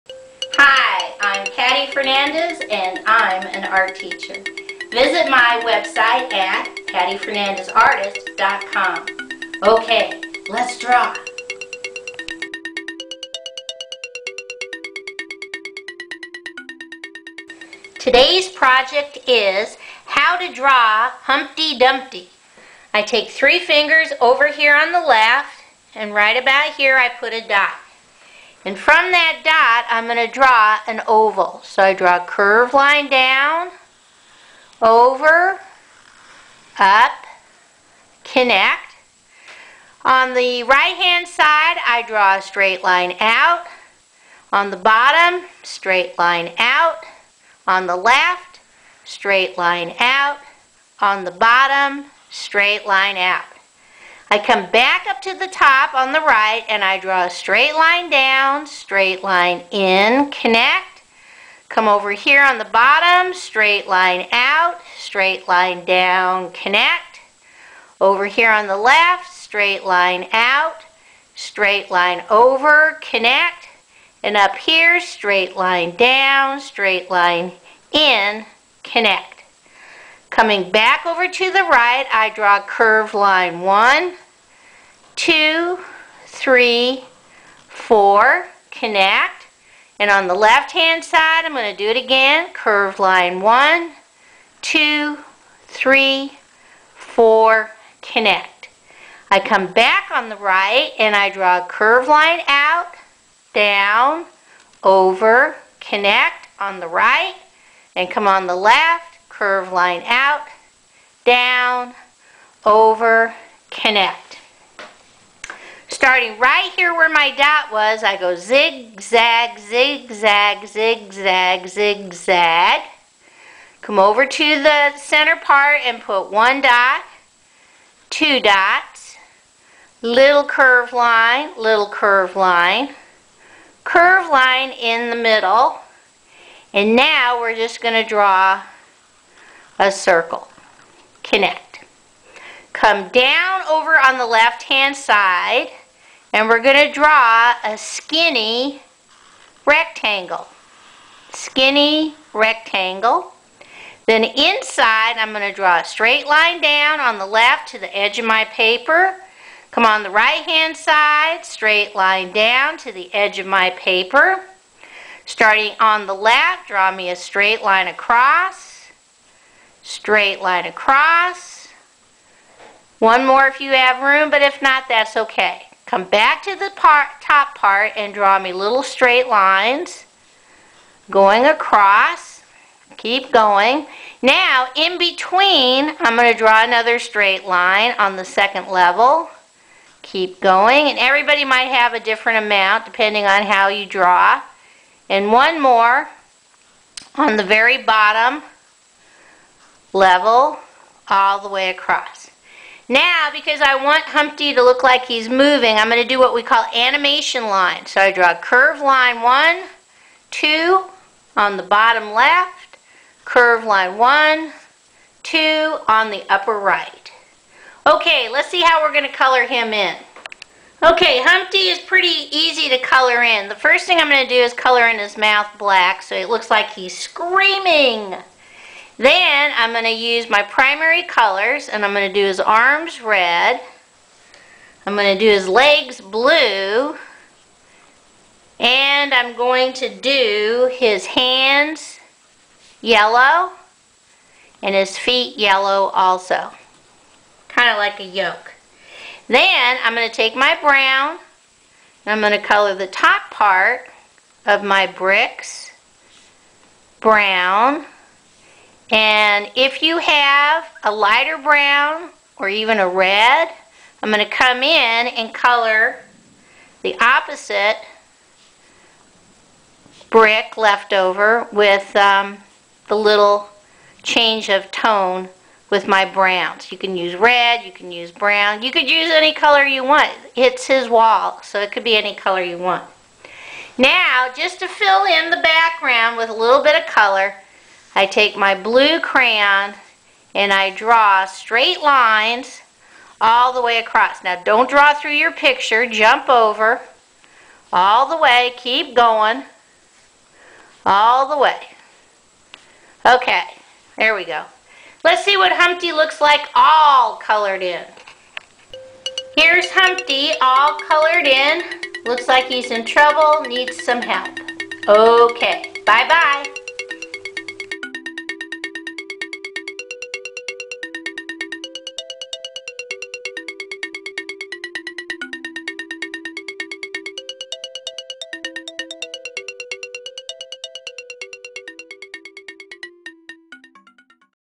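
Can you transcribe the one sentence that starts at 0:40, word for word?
On the right-hand side, I draw a straight line out.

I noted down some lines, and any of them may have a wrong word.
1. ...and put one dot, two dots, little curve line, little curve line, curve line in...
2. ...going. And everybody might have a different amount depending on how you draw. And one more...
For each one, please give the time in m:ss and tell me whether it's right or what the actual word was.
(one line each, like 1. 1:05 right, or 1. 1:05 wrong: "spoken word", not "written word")
1. 2:05 right
2. 3:10 right.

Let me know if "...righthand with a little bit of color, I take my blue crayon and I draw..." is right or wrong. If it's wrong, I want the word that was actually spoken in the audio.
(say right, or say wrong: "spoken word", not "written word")
wrong: "background", not "righthand".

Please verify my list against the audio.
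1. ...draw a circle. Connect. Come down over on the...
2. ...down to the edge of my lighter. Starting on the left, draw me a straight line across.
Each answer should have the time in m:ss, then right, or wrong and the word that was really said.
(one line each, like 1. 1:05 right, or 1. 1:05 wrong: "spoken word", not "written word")
1. 2:18 right
2. 2:42 wrong: "paper", not "lighter".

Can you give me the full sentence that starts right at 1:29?
And on the left-hand side, I'm going to do it again.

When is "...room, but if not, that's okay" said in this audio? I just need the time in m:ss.
2:54.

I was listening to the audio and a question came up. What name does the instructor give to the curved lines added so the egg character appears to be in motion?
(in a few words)
animation line.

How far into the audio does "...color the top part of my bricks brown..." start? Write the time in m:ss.
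4:12.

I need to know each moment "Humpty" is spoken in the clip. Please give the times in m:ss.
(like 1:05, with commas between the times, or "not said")
0:21, 3:24, 3:41, 5:05, 5:09.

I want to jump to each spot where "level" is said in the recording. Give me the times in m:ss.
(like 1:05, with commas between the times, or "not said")
3:08, 3:19.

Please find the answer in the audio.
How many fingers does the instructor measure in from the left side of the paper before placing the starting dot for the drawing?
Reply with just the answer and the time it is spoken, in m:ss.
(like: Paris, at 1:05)
3, at 0:23.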